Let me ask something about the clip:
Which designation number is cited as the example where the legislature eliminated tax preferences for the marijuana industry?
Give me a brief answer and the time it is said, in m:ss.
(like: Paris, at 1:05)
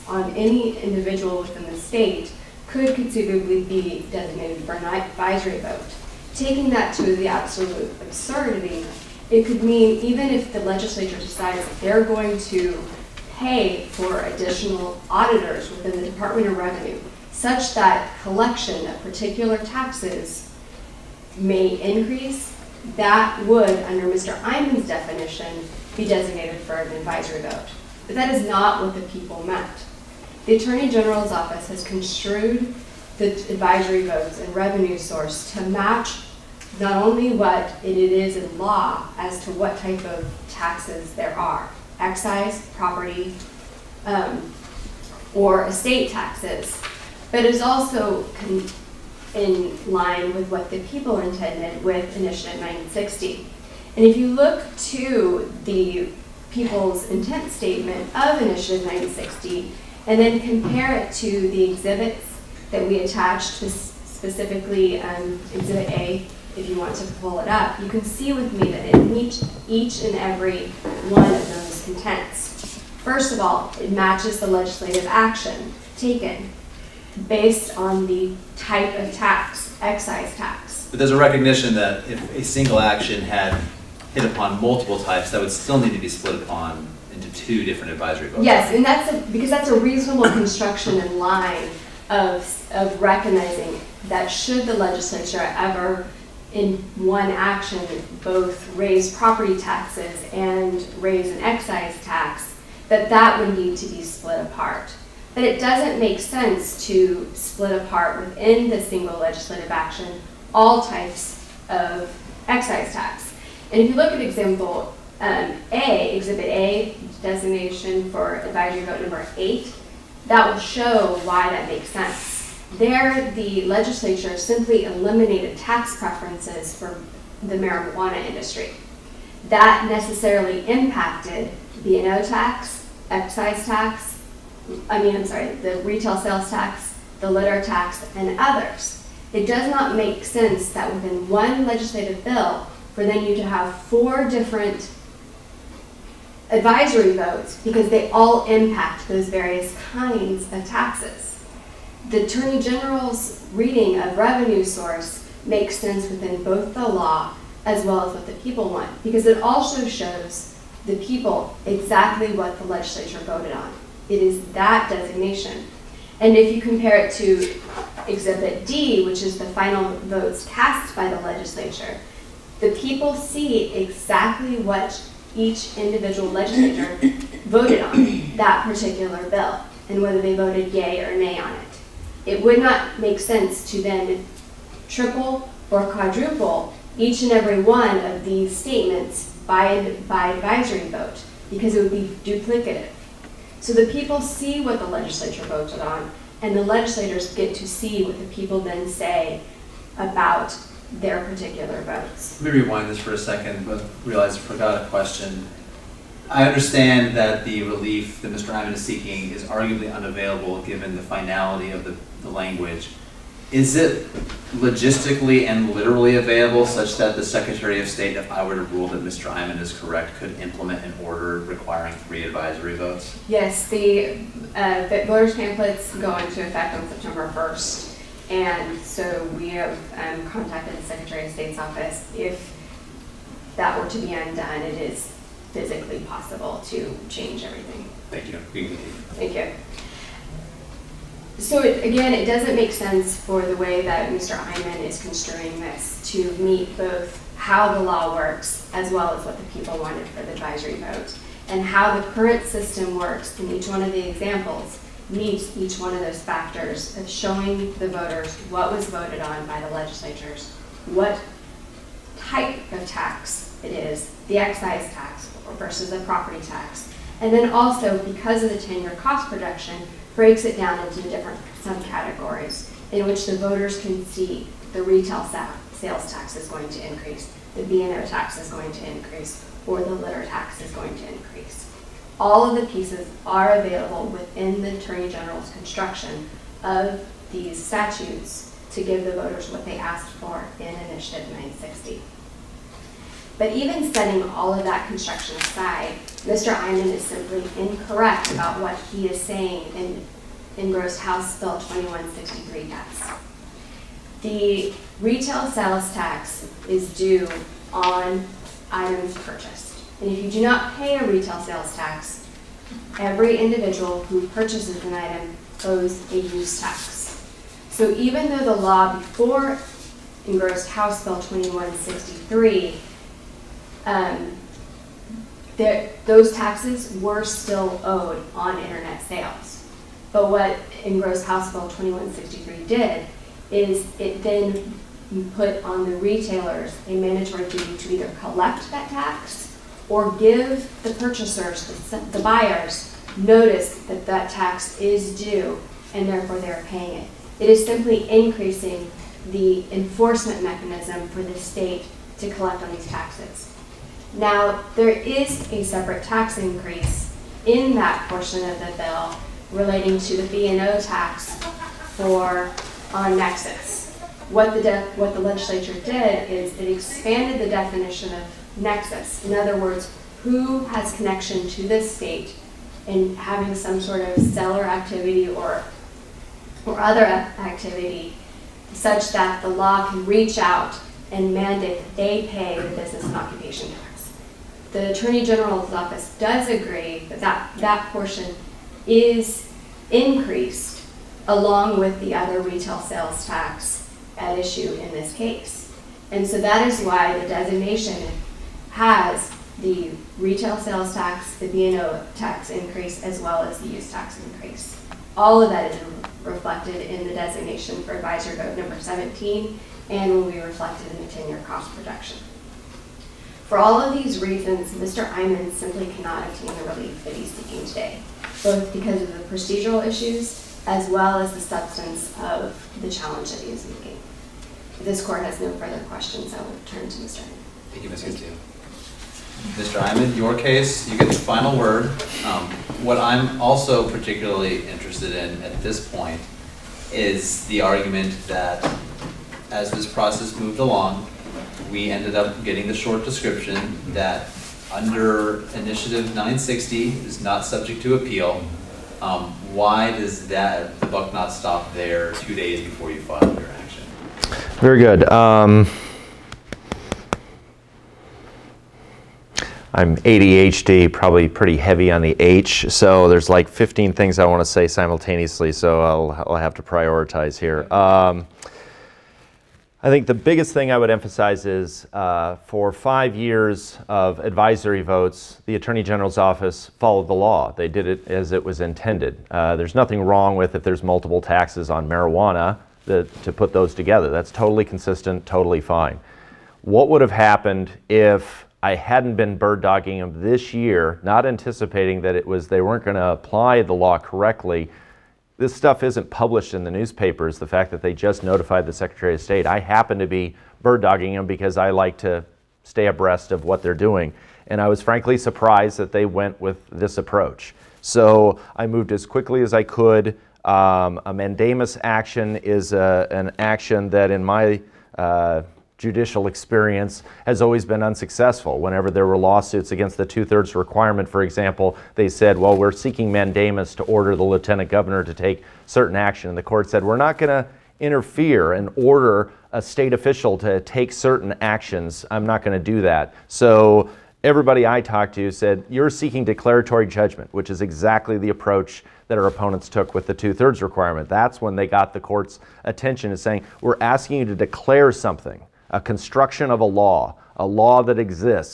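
8, at 1:57.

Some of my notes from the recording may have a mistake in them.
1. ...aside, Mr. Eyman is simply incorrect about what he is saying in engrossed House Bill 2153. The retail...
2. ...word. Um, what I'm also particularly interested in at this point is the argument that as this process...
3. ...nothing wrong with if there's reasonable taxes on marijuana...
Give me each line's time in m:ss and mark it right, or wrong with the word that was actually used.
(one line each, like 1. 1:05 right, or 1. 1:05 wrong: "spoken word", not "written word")
1. 4:55 wrong: "2163", not "2153"
2. 7:11 right
3. 7:59 wrong: "multiple", not "reasonable".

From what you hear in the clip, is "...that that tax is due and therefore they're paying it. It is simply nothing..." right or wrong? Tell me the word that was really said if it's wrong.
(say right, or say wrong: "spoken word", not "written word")
wrong: "increasing", not "nothing".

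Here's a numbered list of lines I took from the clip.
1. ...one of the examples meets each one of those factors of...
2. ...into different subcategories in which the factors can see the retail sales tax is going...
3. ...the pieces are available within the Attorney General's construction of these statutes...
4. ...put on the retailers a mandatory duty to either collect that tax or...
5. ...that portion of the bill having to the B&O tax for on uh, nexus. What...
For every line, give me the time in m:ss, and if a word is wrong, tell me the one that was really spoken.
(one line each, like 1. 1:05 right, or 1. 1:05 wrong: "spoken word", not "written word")
1. 4:13 right
2. 4:30 wrong: "voters", not "factors"
3. 4:42 right
4. 5:35 right
5. 5:57 wrong: "relating", not "having".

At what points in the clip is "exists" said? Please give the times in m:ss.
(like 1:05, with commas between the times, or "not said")
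9:07.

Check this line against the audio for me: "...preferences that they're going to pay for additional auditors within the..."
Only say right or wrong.
wrong.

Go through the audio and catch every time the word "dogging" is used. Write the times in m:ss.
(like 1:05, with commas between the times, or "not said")
8:09, 8:20.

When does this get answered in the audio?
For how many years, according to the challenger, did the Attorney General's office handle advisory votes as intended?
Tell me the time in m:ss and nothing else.
7:52.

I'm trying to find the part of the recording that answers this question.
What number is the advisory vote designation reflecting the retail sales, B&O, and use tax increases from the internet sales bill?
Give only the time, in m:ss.
6:47.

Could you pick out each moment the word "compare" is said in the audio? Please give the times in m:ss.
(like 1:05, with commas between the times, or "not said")
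1:00, 2:46.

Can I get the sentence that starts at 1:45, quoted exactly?
That it doesn't make sense to split apart within the single legislative action all types of excise tax.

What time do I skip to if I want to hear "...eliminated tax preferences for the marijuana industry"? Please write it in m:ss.
2:04.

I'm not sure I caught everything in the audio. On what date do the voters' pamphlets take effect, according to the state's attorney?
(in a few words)
September 1.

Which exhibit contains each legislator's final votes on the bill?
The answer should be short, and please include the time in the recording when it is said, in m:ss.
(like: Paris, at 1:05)
Exhibit D, at 2:48.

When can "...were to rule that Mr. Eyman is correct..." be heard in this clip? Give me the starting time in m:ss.
3:38.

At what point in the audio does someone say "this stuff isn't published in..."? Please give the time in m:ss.
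8:15.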